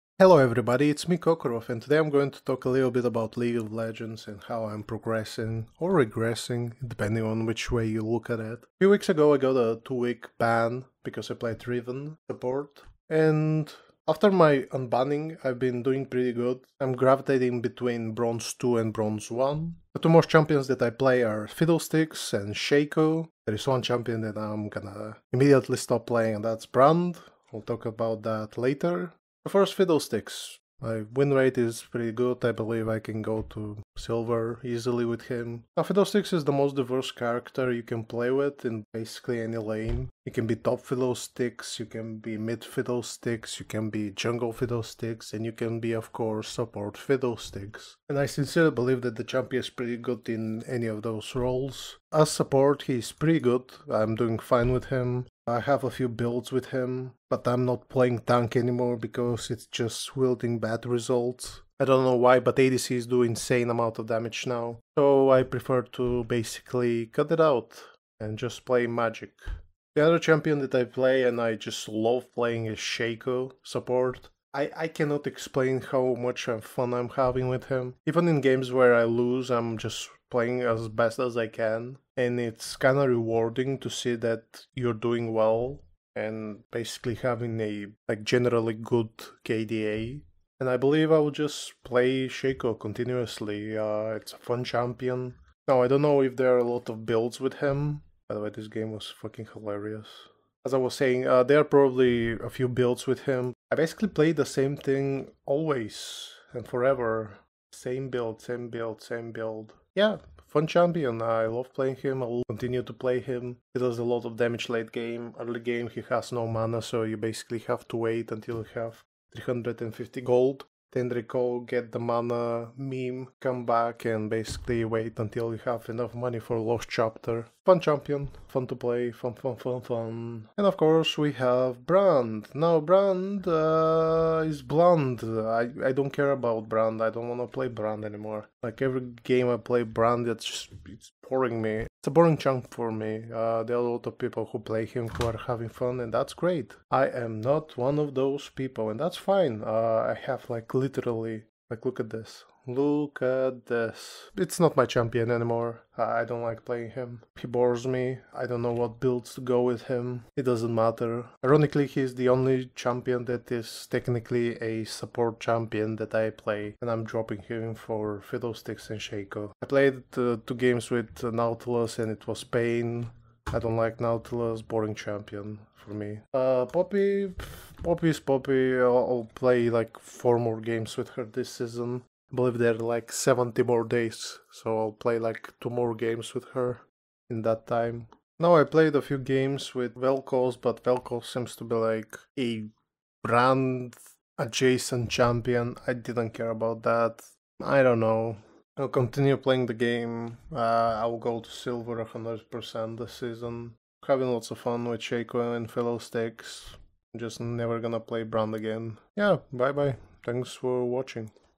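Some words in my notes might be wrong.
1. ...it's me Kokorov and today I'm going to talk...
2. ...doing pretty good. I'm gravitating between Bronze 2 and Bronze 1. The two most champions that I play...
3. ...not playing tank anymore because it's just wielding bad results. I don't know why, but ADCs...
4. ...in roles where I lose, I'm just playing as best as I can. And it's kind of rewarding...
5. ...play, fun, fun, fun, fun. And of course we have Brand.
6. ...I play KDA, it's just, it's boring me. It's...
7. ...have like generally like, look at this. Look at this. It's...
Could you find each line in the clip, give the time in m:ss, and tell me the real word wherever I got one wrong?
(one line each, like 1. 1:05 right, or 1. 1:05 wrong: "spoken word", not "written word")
1. 0:00 right
2. 0:15 right
3. 0:57 right
4. 1:18 wrong: "games", not "roles"
5. 2:08 right
6. 2:19 wrong: "Brand", not "KDA"
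7. 2:30 wrong: "literally", not "generally".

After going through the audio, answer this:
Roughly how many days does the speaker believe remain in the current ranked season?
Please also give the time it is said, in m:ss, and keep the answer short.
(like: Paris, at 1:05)
70, at 3:03.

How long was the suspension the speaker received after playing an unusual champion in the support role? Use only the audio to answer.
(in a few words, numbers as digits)
two week.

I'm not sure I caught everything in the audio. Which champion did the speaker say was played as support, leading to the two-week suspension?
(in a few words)
Riven.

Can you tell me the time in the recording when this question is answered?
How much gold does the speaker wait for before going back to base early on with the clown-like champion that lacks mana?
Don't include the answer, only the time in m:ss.
1:59.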